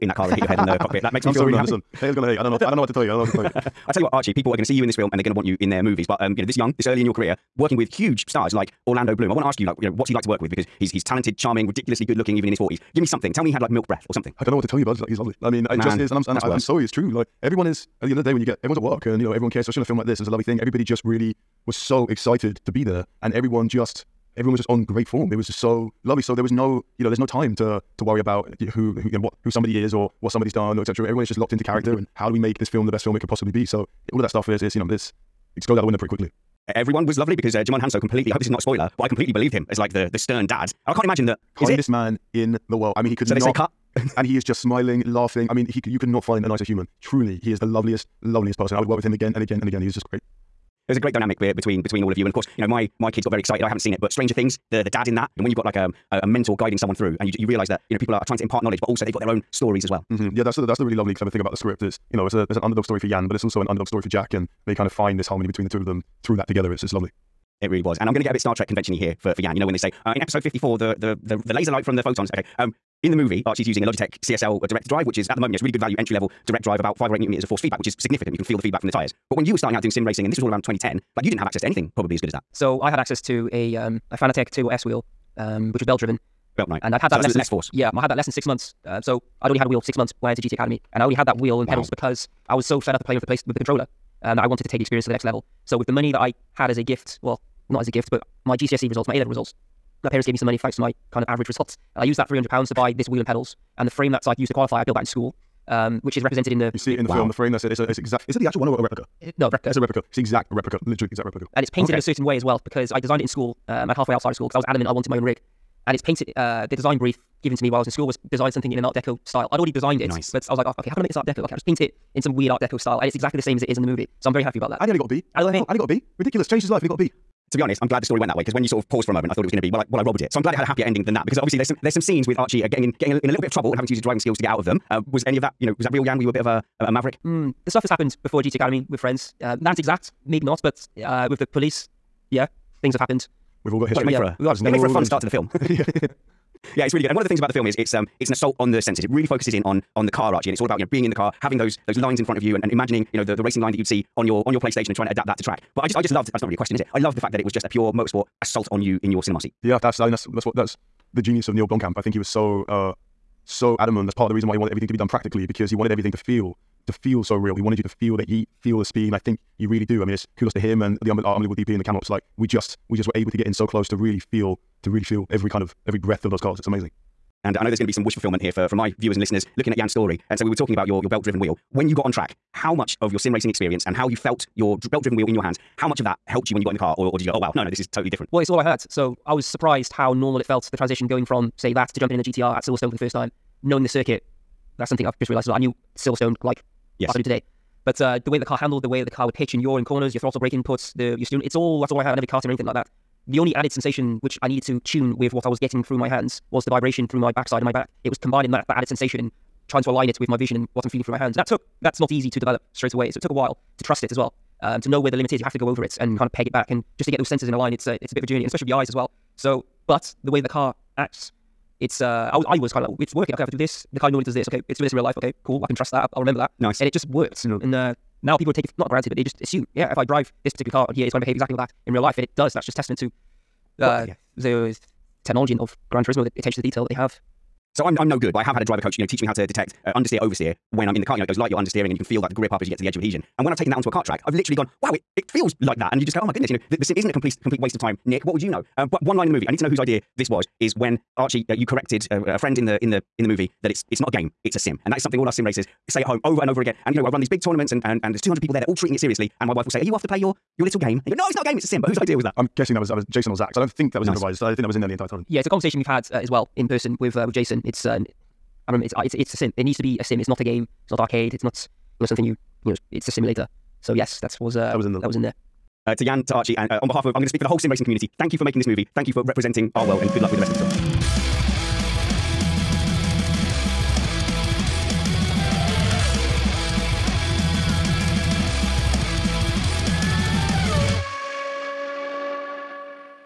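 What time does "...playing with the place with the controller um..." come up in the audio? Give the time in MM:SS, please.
01:33.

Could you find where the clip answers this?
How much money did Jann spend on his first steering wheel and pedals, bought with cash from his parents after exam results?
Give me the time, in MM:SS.
01:42.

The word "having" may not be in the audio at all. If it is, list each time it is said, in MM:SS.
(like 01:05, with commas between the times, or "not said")
02:13, 02:31.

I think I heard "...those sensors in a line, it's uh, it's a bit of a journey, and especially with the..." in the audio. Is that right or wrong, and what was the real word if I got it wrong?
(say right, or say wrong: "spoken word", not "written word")
right.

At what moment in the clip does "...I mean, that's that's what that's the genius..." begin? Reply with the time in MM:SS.
02:39.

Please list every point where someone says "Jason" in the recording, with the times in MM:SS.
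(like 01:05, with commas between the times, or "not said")
04:23, 04:27.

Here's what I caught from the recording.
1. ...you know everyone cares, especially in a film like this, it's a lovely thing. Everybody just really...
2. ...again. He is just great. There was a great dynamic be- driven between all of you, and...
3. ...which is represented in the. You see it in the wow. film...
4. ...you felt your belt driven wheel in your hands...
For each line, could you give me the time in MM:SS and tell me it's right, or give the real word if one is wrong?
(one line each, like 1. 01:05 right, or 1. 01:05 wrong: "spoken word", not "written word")
1. 00:19 right
2. 00:49 wrong: "between", not "driven"
3. 01:46 right
4. 03:04 right.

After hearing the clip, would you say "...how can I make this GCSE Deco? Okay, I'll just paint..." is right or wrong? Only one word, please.
wrong.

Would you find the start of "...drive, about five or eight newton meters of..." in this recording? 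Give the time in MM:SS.
01:16.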